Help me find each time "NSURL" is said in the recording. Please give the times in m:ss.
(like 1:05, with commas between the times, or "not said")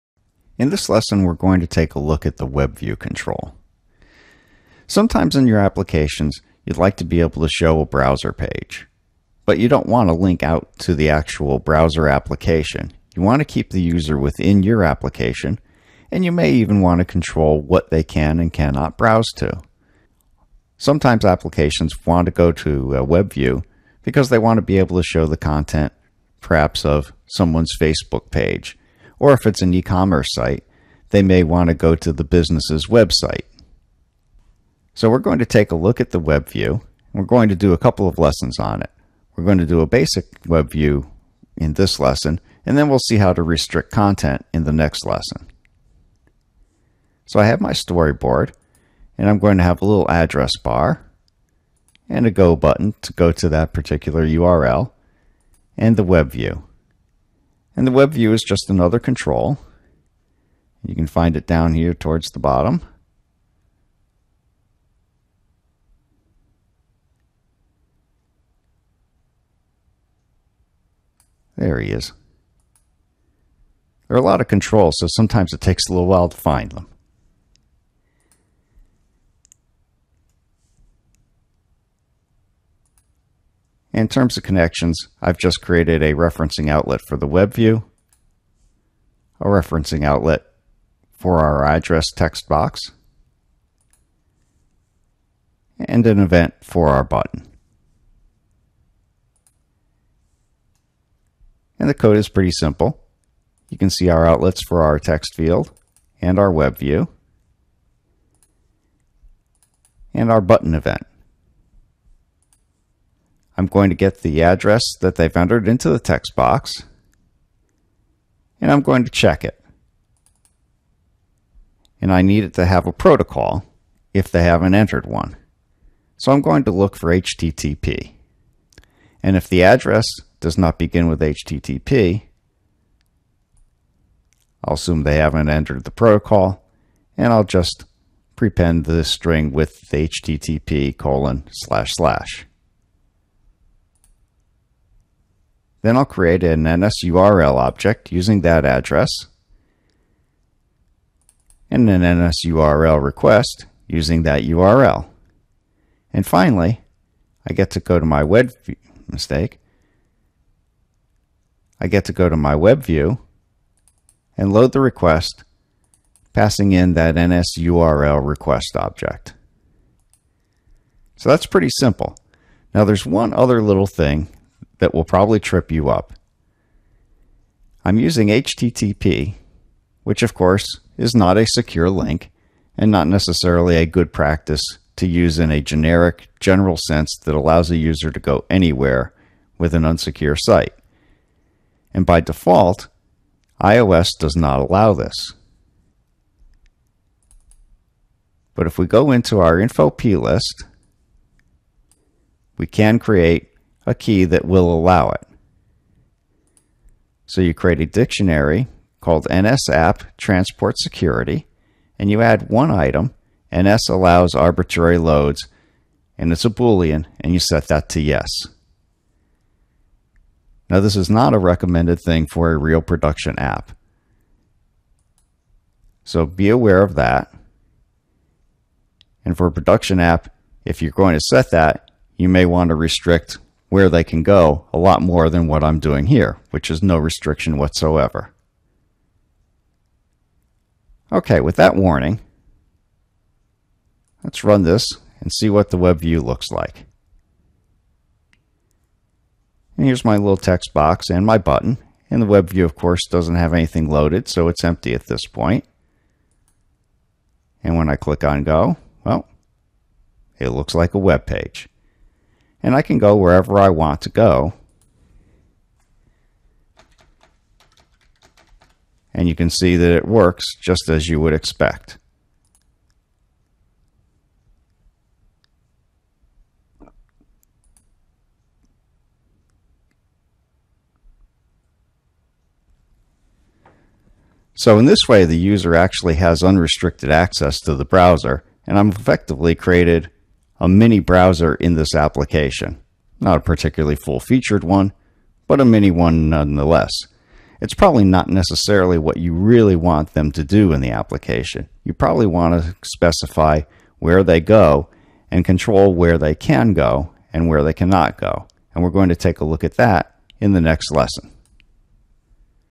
2:26, 2:32, 2:47.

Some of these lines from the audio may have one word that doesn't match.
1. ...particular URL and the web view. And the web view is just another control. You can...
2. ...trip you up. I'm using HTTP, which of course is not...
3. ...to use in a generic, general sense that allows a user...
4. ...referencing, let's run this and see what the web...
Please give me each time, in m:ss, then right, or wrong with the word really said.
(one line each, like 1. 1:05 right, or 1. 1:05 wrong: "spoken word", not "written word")
1. 0:53 right
2. 2:55 right
3. 3:04 right
4. 4:01 wrong: "warning", not "referencing".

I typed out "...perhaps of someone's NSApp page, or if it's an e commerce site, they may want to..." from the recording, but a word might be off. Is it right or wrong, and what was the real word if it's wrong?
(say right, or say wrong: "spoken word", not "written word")
wrong: "Facebook", not "NSApp".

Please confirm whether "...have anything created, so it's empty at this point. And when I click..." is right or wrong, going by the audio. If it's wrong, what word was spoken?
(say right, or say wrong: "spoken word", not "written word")
wrong: "loaded", not "created".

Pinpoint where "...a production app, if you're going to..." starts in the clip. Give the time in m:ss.
3:49.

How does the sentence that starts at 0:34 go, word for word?
So we're going to take a look at the web view.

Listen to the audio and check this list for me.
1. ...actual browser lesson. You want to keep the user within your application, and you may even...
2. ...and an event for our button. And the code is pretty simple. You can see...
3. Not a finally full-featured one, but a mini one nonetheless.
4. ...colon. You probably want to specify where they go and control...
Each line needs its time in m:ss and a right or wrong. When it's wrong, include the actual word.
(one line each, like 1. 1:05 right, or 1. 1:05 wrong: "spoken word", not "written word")
1. 0:11 wrong: "application", not "lesson"
2. 1:35 right
3. 4:53 wrong: "particularly", not "finally"
4. 5:00 wrong: "application", not "colon".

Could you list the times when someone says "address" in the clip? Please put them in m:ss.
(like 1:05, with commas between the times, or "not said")
0:50, 1:31, 1:54, 2:09, 2:28.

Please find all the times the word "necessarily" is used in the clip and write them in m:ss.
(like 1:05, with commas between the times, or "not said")
3:03, 4:58.